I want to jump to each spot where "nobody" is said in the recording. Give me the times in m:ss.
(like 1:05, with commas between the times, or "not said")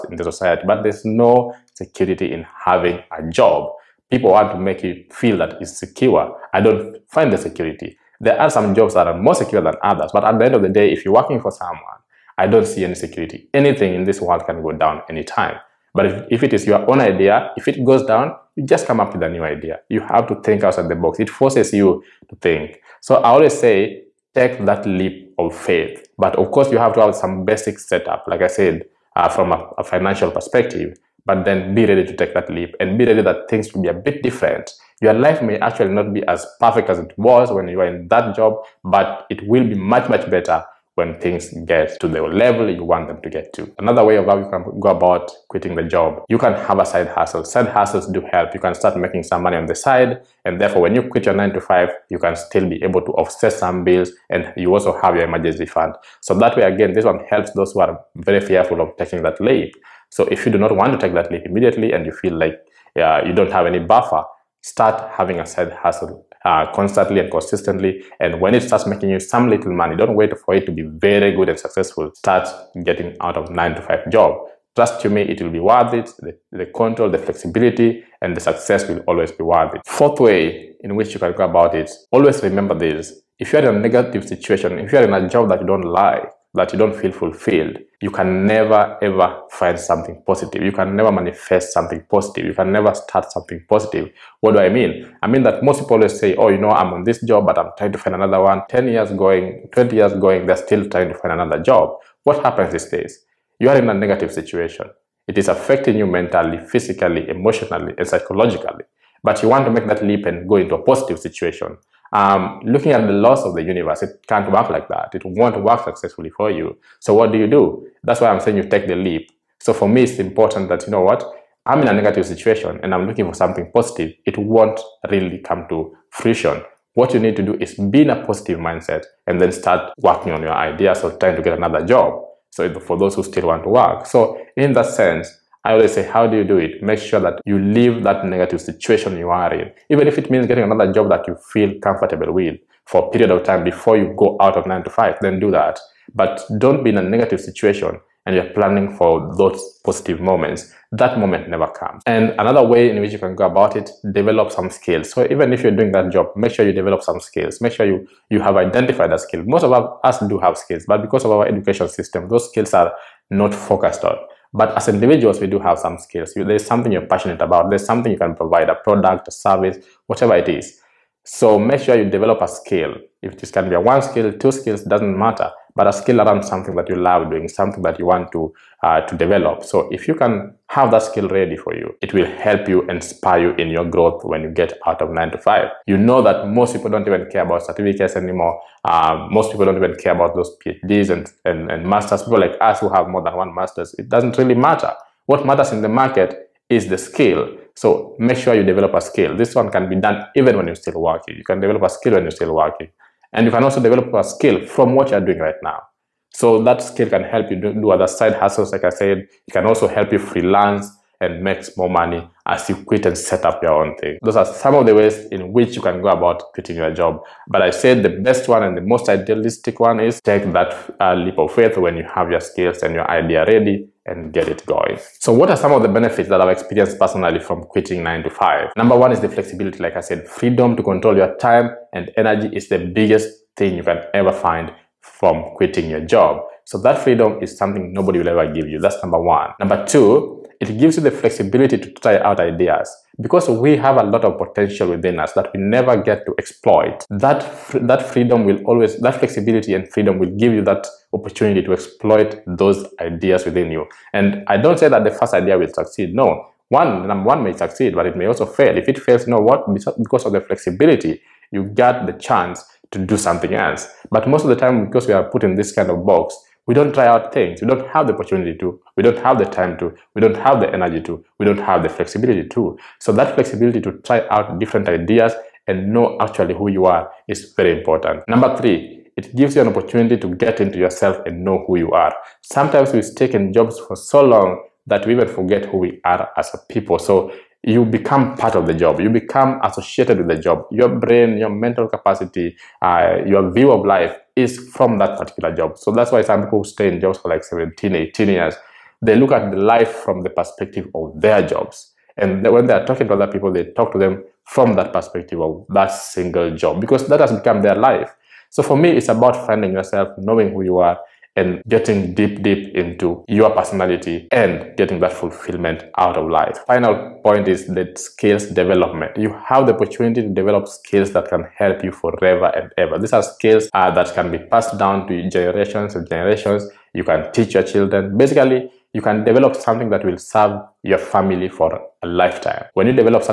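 3:57.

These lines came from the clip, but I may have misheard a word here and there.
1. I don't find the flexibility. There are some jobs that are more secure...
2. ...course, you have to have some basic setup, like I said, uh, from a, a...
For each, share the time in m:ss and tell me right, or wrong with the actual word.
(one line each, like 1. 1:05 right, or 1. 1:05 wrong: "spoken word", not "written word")
1. 0:06 wrong: "security", not "flexibility"
2. 0:26 right.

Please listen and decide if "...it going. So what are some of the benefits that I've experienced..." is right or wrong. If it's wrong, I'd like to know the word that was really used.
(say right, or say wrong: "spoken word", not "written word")
right.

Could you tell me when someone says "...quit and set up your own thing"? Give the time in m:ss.
3:32.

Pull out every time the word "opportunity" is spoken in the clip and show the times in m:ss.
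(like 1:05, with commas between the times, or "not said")
4:11, 4:28, 4:39, 5:19.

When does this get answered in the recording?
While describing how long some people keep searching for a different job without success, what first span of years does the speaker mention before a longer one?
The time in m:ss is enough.
1:38.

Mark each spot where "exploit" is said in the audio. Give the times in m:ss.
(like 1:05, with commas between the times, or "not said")
4:06, 4:11.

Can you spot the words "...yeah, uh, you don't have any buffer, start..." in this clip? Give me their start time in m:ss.
1:02.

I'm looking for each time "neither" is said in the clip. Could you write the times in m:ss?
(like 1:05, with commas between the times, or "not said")
not said.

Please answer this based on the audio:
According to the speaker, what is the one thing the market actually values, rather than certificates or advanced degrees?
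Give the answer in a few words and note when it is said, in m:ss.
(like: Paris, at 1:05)
the skill, at 3:16.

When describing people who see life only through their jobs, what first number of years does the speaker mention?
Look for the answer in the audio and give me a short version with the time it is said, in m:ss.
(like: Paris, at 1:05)
17, at 4:57.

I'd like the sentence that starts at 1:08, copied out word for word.
And when it starts making you some little money, don't wait for it to be very good and successful.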